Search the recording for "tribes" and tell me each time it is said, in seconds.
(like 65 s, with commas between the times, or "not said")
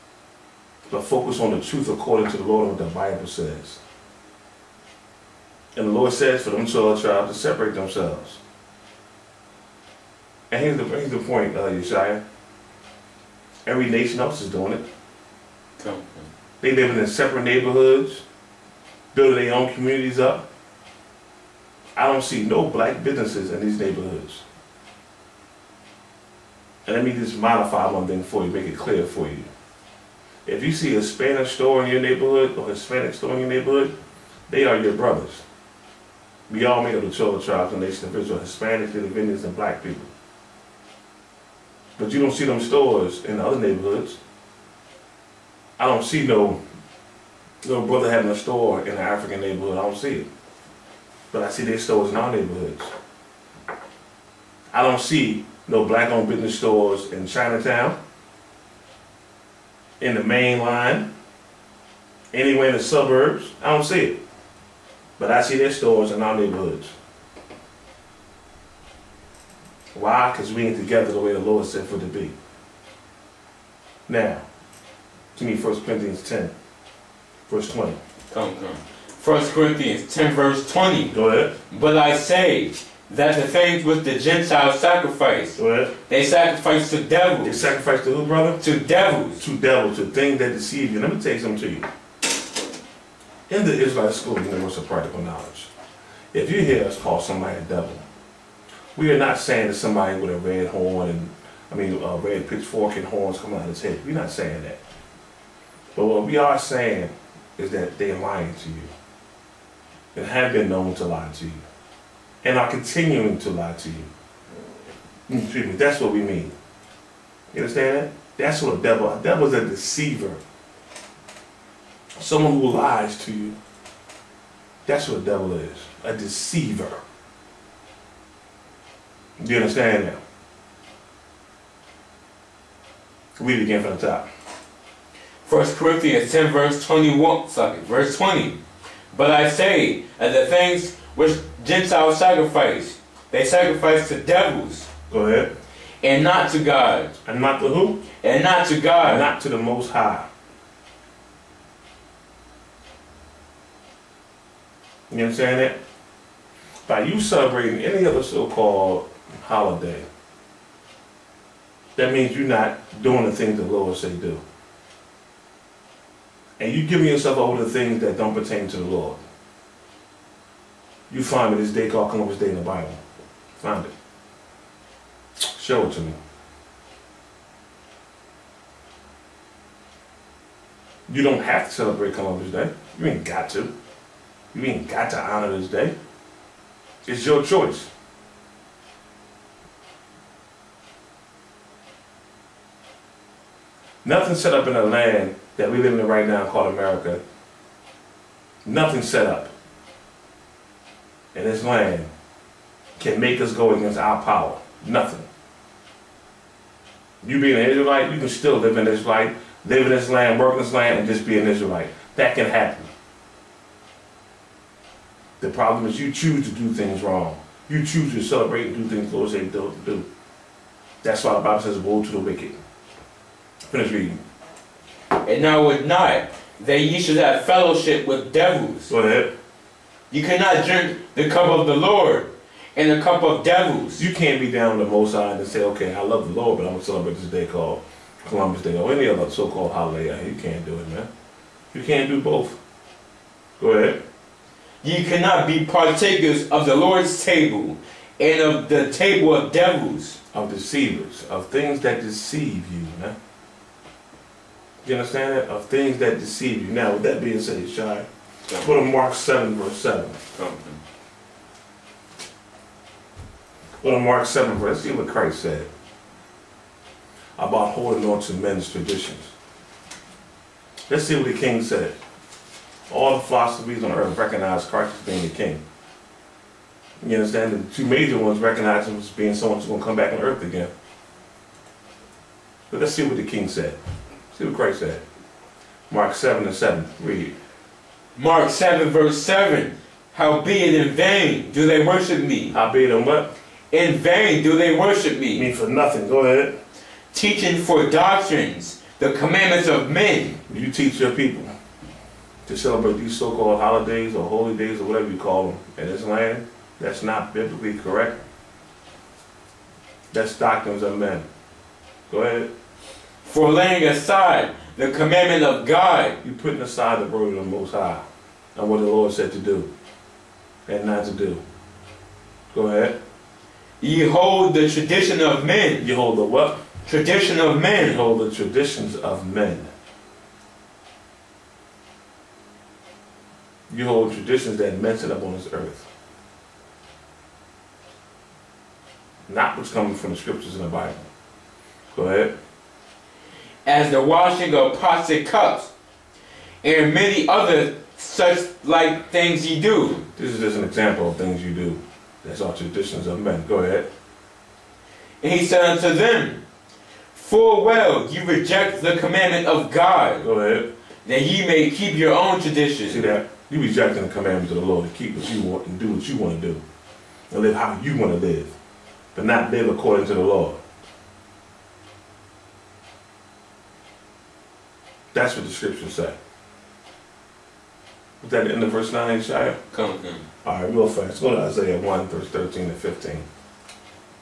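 7 s, 37 s.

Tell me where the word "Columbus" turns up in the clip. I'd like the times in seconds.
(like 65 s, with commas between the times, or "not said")
172 s, 182 s, 238 s.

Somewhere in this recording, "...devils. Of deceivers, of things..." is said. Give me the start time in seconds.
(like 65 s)
249 s.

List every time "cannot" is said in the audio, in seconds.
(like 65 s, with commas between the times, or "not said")
230 s, 245 s.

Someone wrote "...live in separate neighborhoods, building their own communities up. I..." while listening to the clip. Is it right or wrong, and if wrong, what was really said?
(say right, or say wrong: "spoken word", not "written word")
right.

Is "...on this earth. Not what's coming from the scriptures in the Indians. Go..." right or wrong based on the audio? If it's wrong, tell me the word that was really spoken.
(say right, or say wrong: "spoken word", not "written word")
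wrong: "Bible", not "Indians".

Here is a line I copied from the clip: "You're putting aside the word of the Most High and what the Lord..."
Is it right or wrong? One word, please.
right.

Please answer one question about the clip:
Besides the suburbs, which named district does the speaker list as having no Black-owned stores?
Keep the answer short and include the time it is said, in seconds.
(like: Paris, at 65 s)
Chinatown, at 57 s.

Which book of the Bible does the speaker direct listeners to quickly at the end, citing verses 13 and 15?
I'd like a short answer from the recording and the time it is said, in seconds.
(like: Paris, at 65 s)
Isaiah, at 381 s.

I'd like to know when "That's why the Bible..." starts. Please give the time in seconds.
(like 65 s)
221 s.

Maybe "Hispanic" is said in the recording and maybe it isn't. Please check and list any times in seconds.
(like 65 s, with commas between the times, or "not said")
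32 s, 38 s.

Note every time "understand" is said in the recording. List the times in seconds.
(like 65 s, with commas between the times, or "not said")
117 s, 129 s, 254 s, 277 s.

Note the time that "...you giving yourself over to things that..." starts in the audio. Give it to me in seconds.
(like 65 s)
166 s.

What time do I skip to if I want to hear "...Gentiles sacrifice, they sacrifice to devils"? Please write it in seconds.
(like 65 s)
141 s.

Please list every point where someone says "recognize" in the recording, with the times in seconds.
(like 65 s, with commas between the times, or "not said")
274 s, 278 s.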